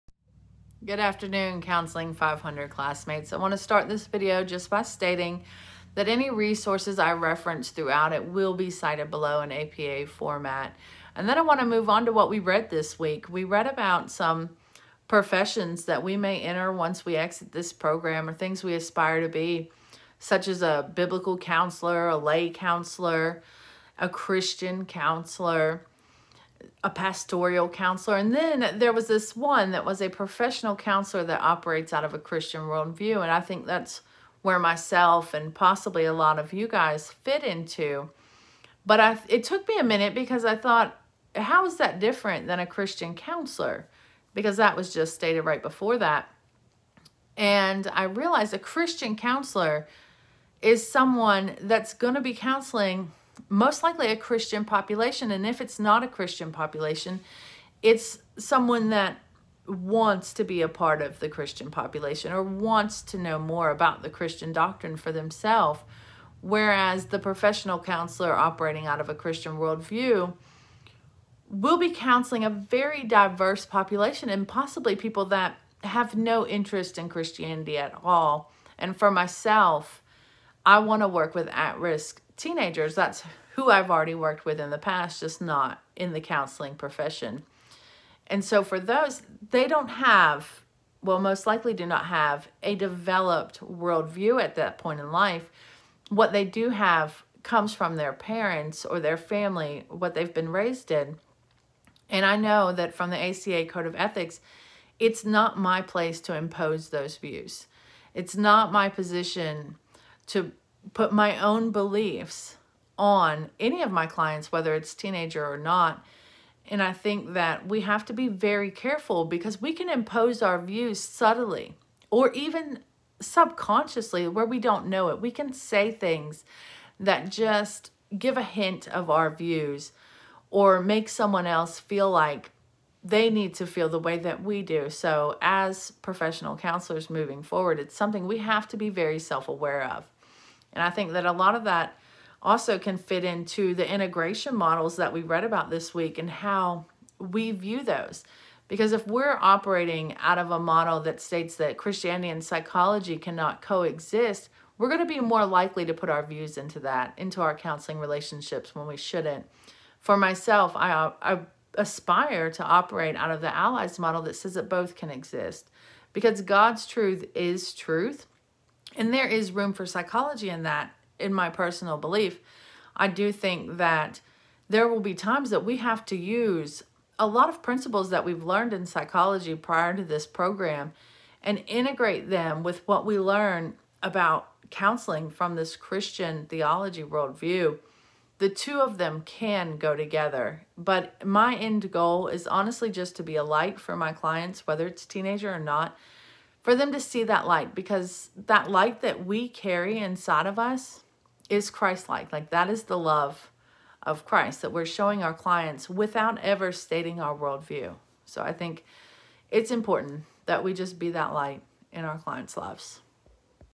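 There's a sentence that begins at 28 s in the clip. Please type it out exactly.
And then there was this one that was a professional counselor that operates out of a Christian worldview.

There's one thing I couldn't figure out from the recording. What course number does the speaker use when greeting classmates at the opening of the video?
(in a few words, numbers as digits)
Counseling 500.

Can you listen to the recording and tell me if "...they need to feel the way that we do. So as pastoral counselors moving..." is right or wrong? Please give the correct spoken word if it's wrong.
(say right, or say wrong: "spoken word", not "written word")
wrong: "professional", not "pastoral".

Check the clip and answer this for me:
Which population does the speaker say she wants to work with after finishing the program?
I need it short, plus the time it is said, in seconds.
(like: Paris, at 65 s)
At risk teenagers, at 81 s.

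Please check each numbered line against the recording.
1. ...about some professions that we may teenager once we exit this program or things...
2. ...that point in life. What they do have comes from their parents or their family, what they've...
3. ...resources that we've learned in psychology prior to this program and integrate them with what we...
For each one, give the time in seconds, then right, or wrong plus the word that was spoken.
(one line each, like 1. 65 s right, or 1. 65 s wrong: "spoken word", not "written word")
1. 13 s wrong: "enter", not "teenager"
2. 94 s right
3. 177 s wrong: "principles", not "resources".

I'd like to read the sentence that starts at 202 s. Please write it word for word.
Like that is the love of Christ that we're showing our clients without ever stating our worldview.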